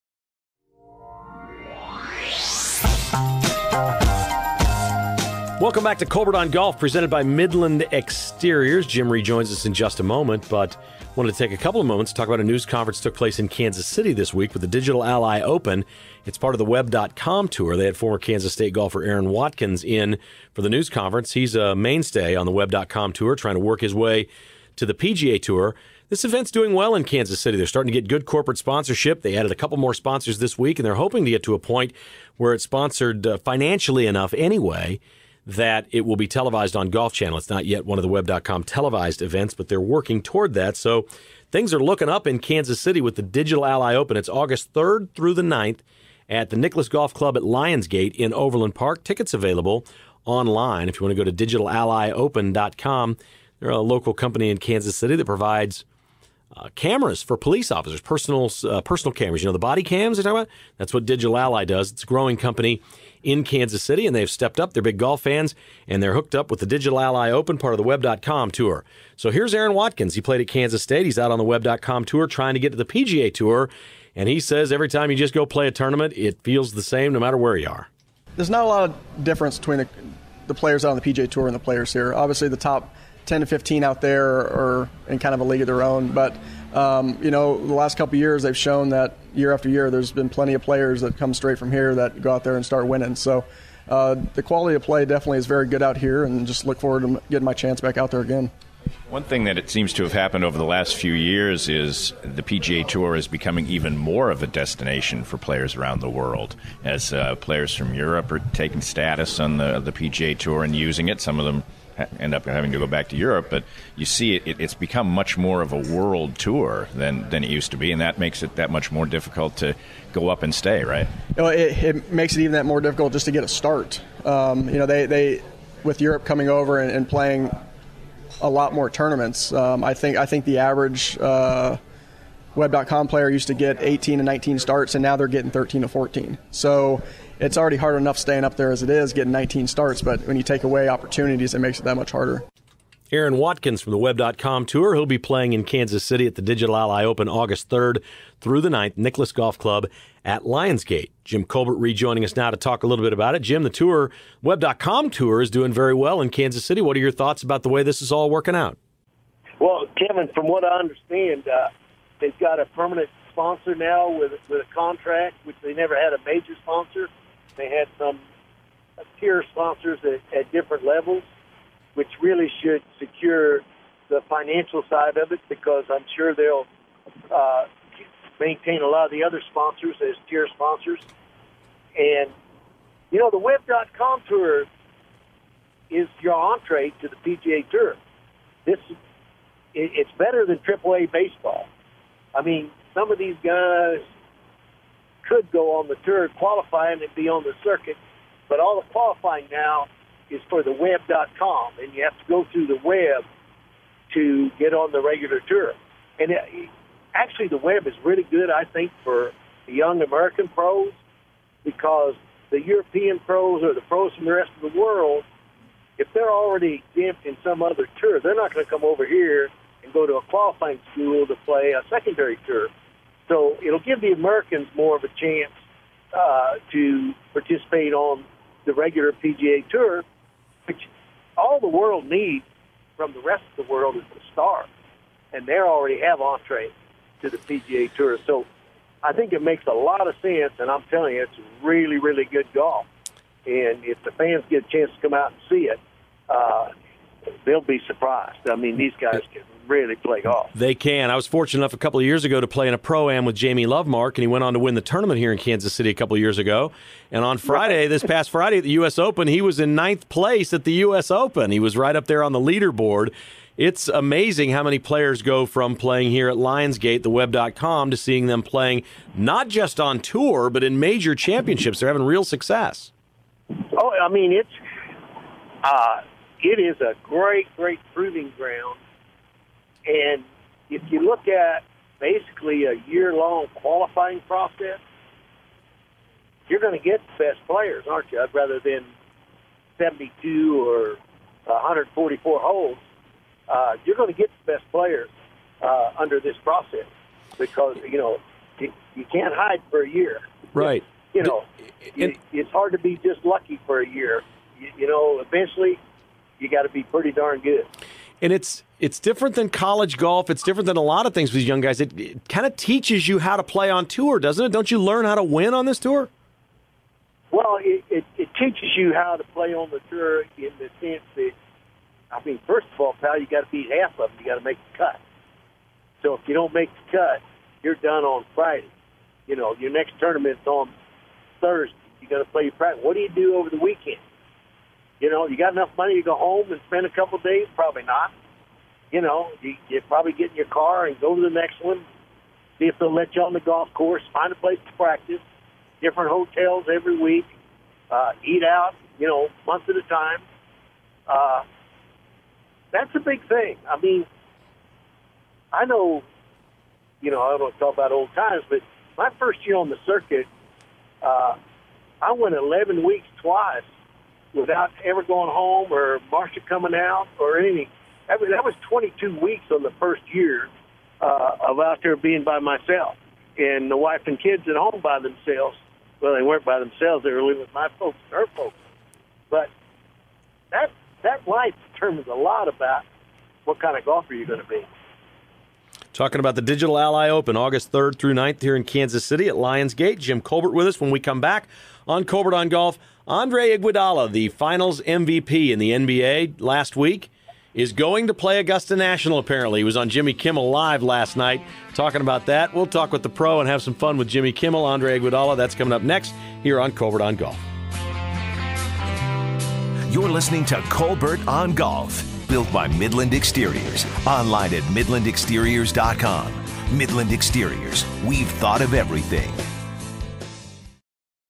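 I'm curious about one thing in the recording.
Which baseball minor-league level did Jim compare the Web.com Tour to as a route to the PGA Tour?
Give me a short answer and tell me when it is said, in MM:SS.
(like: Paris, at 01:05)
AAA, at 03:10.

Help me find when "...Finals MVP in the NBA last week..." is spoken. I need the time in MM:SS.
06:34.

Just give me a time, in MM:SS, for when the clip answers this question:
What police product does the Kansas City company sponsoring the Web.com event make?
00:59.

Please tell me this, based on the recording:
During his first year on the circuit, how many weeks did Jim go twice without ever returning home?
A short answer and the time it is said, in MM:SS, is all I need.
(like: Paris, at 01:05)
11, at 06:02.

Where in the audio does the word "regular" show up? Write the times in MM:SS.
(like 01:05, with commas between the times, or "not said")
03:25, 03:48.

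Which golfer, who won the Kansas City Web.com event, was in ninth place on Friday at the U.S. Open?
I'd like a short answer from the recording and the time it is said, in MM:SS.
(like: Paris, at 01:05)
Jamie Lovemark, at 04:13.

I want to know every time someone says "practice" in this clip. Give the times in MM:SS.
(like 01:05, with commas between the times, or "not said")
05:32, 05:44.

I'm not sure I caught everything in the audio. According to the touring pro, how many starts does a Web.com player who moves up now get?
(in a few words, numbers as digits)
13 to 14.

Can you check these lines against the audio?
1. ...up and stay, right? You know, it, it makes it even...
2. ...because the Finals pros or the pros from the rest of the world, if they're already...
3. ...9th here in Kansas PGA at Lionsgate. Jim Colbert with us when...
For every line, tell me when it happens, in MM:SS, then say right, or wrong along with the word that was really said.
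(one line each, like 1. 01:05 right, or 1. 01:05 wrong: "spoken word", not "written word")
1. 02:00 right
2. 03:31 wrong: "European", not "Finals"
3. 06:28 wrong: "City", not "PGA".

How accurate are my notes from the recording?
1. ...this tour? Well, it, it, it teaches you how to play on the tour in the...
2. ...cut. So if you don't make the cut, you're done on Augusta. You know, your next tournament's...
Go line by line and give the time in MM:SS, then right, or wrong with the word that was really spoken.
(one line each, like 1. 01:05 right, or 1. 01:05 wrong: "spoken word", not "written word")
1. 05:15 right
2. 05:24 wrong: "Friday", not "Augusta".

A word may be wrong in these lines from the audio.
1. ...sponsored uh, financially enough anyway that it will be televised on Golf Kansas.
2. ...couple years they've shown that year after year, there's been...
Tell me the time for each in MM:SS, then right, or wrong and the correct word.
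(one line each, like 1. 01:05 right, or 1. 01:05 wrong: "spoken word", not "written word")
1. 00:32 wrong: "Channel", not "Kansas"
2. 01:27 right.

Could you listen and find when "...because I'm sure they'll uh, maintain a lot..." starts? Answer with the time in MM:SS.
02:55.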